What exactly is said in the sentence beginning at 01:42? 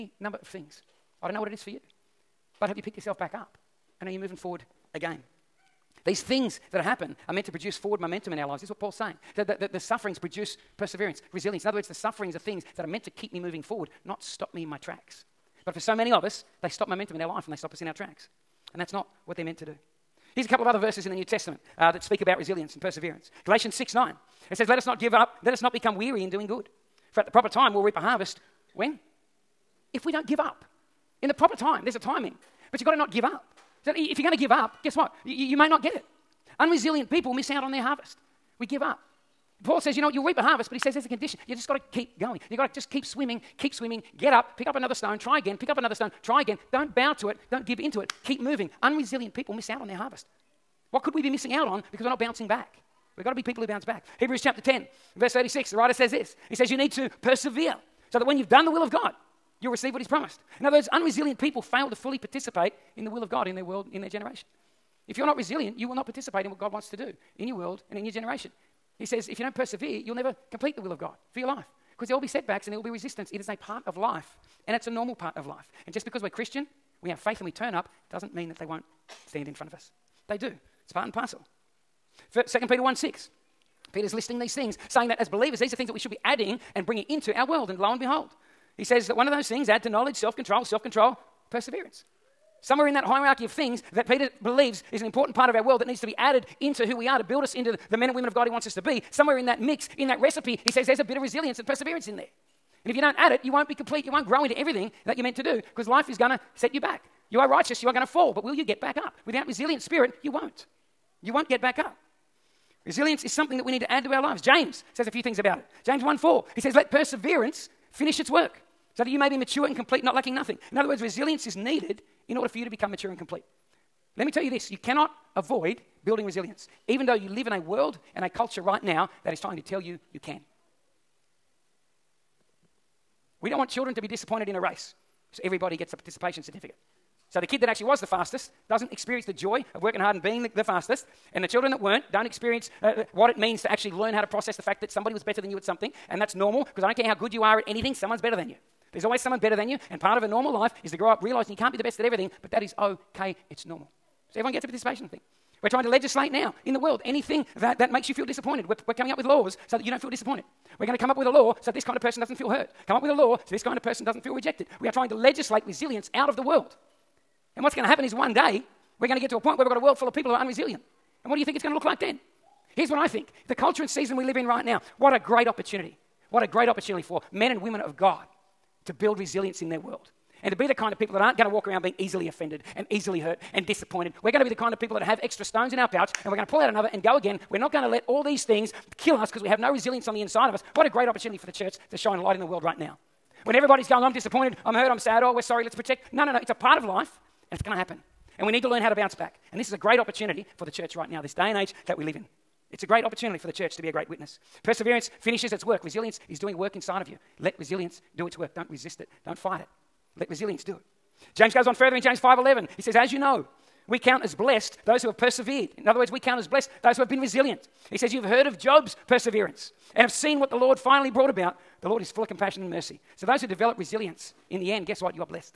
And if you don't add it, you won't be complete.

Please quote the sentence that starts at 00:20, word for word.
Here's a couple of other verses in the New Testament uh, that speak about resilience and perseverance.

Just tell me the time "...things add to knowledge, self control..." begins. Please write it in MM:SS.
01:29.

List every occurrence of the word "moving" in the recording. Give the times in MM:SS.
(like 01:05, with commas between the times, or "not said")
00:04, 00:13, 00:48.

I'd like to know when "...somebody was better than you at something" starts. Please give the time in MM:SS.
02:24.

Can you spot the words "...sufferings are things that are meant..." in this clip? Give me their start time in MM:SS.
00:11.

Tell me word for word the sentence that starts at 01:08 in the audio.
He says, if you don't persevere, you'll never complete the will of God for your life.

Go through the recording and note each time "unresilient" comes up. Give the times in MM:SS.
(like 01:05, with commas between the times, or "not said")
00:36, 00:48, 01:00, 02:50.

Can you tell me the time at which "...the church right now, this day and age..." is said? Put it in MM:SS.
03:20.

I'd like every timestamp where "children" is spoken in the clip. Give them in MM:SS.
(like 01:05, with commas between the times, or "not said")
02:13, 02:21.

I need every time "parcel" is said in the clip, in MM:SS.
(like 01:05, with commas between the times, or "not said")
01:21.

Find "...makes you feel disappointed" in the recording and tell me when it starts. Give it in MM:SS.
02:37.